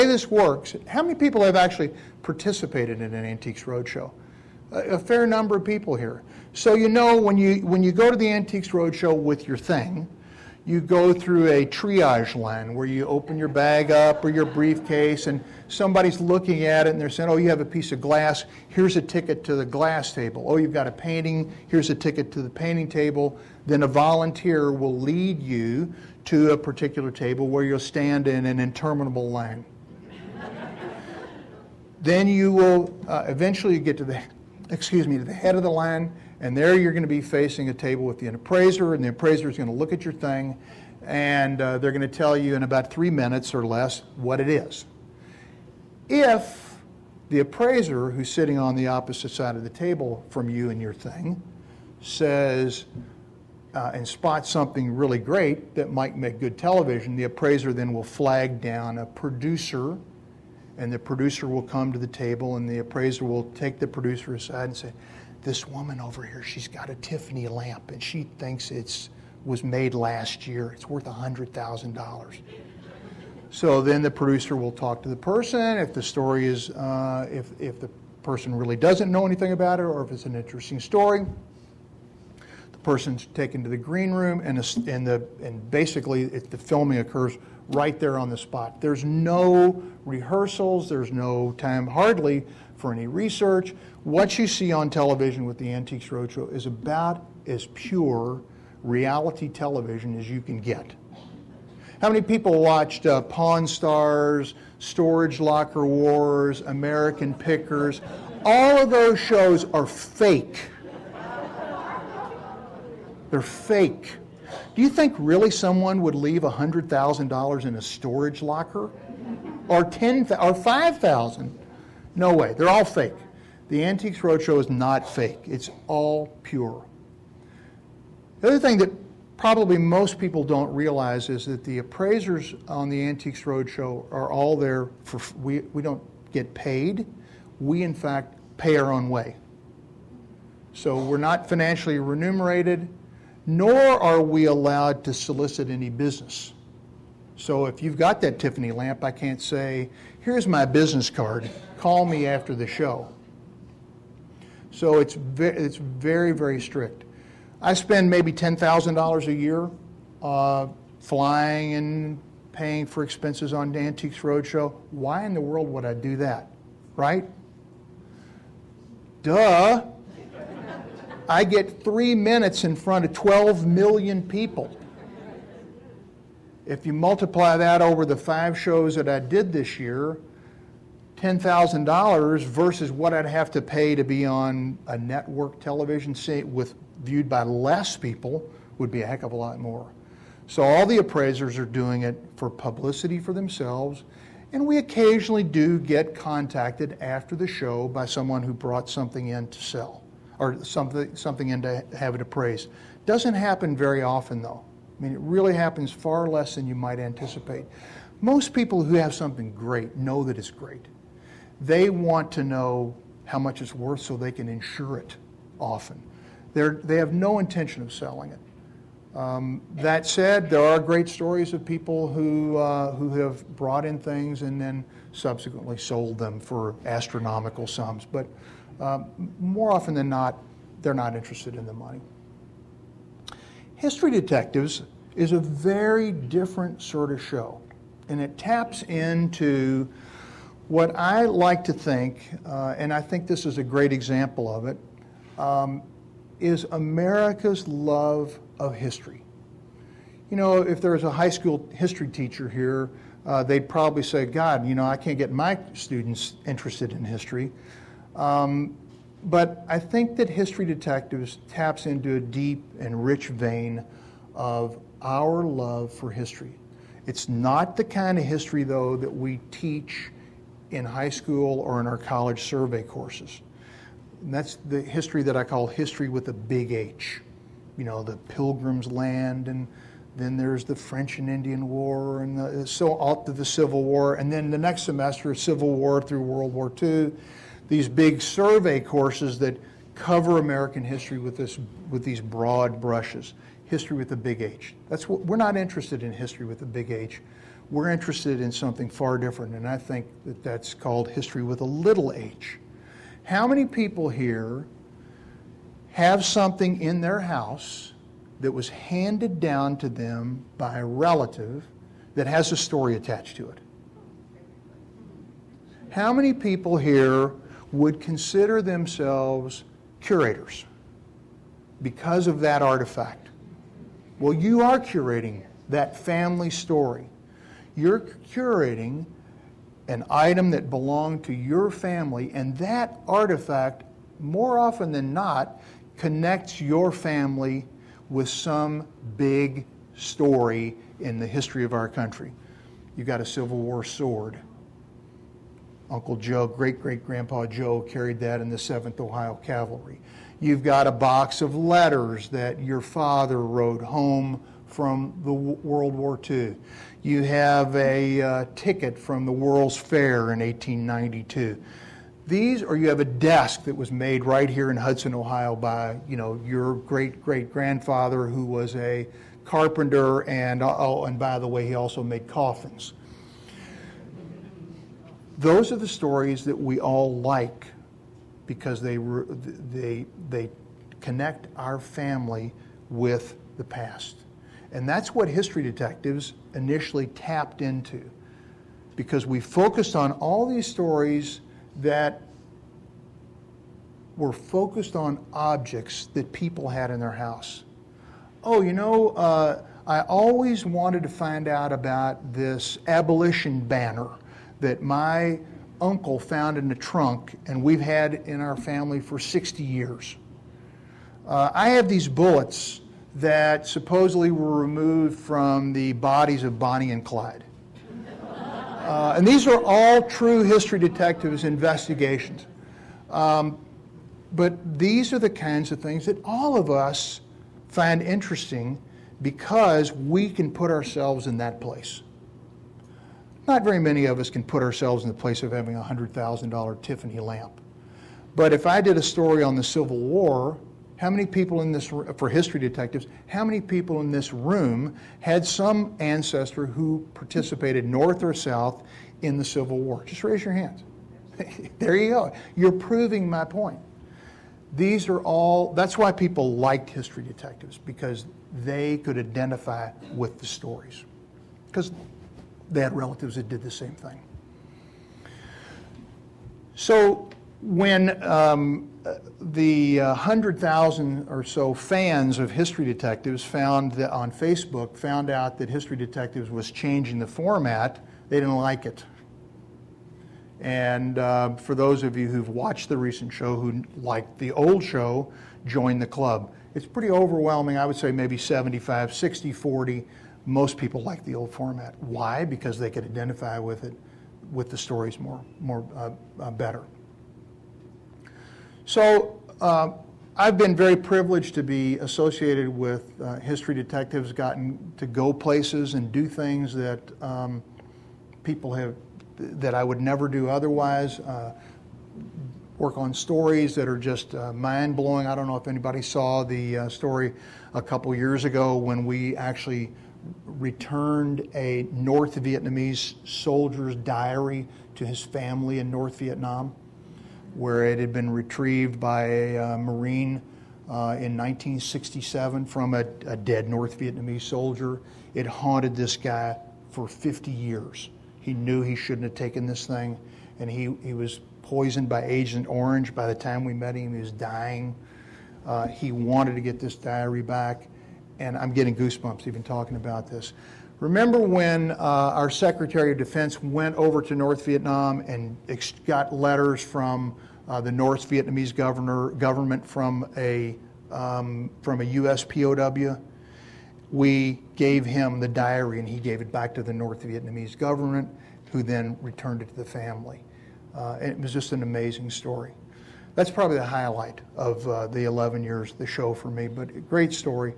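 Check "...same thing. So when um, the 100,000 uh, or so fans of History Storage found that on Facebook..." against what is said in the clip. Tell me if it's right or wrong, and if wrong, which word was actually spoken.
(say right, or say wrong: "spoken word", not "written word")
wrong: "Detectives", not "Storage".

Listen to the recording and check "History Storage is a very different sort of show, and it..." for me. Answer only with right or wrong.
wrong.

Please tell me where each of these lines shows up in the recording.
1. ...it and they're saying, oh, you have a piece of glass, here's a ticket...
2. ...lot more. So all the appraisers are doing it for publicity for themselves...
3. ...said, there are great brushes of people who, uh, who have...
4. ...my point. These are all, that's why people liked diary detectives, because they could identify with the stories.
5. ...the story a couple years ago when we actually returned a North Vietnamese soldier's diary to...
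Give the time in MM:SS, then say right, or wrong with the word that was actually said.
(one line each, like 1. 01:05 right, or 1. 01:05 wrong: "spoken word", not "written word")
1. 00:16 right
2. 03:09 right
3. 03:40 wrong: "stories", not "brushes"
4. 07:33 wrong: "history", not "diary"
5. 08:36 right.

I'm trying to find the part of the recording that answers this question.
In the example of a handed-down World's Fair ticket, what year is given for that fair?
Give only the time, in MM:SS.
06:00.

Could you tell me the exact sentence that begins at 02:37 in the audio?
I spend maybe $10,000 a year uh, flying and paying for expenses on Antiques Roadshow.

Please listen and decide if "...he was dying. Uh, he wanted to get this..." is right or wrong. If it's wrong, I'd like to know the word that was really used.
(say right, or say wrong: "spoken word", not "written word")
right.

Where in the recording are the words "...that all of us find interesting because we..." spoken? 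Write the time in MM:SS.
07:06.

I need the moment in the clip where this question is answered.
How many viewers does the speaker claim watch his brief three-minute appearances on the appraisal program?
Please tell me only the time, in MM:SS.
02:53.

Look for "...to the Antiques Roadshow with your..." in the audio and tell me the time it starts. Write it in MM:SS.
00:08.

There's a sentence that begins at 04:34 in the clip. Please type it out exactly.
And that's the history that I call history with a big H.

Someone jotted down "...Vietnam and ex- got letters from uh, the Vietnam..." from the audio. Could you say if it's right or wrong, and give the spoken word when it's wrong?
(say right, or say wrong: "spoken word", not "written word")
wrong: "North", not "Vietnam".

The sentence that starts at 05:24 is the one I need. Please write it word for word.
Well, you are curating that family story.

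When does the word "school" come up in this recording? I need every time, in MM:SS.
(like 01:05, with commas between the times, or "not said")
04:11, 04:31.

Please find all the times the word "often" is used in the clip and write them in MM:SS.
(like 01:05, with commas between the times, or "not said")
03:24, 03:35, 03:49, 05:34.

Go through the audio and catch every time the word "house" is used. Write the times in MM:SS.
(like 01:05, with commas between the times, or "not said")
05:07, 06:37.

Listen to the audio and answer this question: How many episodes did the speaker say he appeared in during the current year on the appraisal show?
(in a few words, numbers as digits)
5.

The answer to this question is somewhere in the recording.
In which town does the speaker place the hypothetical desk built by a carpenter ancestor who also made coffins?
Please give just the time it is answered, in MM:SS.
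06:04.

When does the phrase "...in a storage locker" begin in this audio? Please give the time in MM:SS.
01:57.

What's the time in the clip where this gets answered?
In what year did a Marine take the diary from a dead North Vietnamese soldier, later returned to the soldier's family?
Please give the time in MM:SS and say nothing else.
08:51.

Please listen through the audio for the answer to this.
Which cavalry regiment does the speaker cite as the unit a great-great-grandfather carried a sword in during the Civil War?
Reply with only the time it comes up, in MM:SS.
05:48.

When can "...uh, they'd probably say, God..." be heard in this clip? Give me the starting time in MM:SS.
04:13.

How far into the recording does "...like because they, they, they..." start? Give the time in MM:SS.
06:17.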